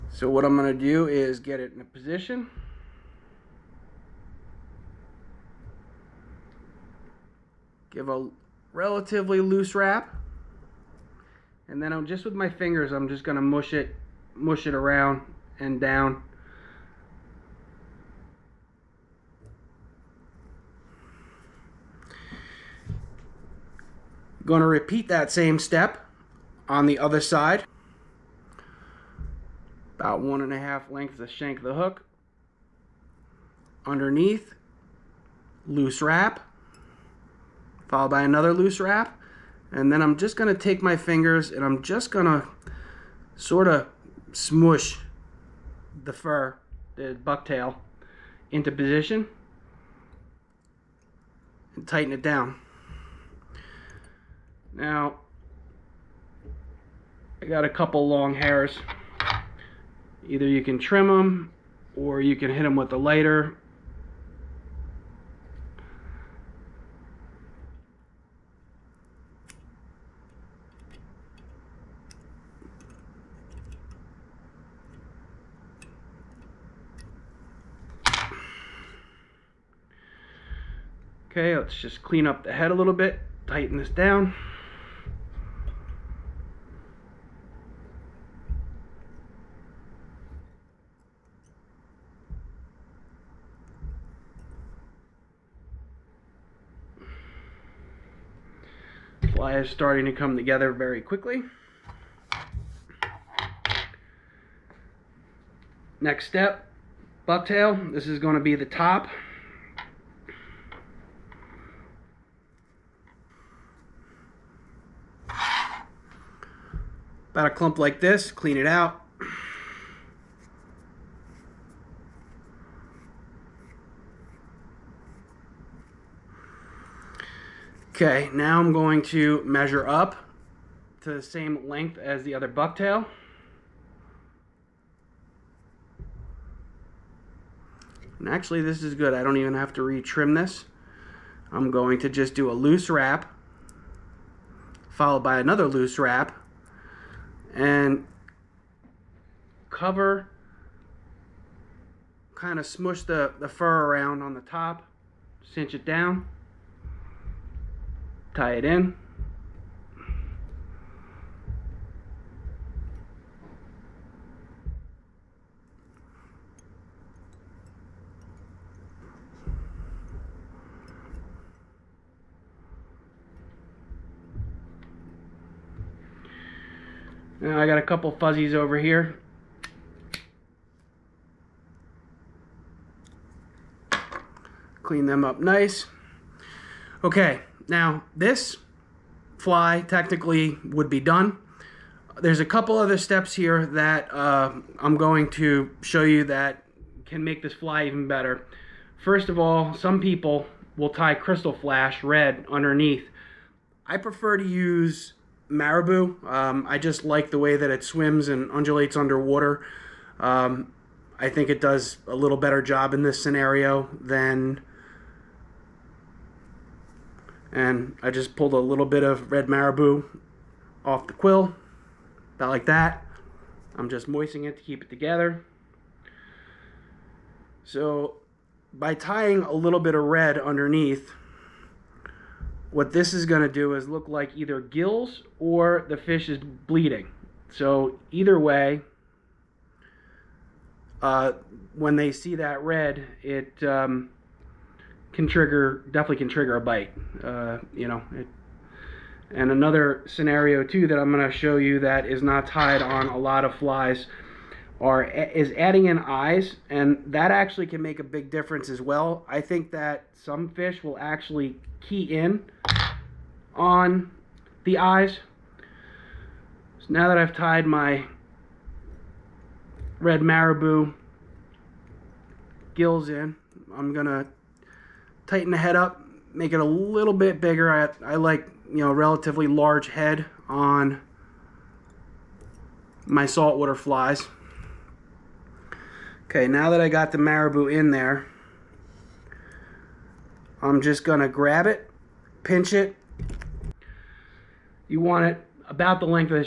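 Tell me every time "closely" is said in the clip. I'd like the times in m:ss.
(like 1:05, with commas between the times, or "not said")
not said.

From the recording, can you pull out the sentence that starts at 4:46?
Okay, now that I got the marabou in there, I'm just going to grab it, pinch it.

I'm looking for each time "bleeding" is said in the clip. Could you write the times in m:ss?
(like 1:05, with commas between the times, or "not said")
3:56.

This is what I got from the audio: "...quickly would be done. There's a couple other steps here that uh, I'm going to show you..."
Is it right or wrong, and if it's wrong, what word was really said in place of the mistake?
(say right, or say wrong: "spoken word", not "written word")
wrong: "technically", not "quickly".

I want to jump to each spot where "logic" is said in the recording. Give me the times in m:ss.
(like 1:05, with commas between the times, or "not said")
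not said.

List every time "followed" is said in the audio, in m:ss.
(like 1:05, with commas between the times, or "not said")
0:37, 2:24.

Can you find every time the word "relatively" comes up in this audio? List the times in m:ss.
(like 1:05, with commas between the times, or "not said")
0:08, 4:38.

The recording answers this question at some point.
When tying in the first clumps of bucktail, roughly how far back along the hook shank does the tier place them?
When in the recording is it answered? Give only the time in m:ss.
0:30.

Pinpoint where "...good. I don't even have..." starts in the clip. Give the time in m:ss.
2:18.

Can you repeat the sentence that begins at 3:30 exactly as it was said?
Um, I think it does a little better job in this scenario than.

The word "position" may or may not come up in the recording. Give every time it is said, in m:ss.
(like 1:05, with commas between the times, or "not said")
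0:01, 0:48.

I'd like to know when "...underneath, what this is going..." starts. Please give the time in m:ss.
3:50.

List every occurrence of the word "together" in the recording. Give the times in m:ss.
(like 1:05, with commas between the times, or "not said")
1:40, 3:44.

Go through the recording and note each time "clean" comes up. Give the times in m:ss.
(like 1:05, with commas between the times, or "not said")
1:22, 1:58, 3:04.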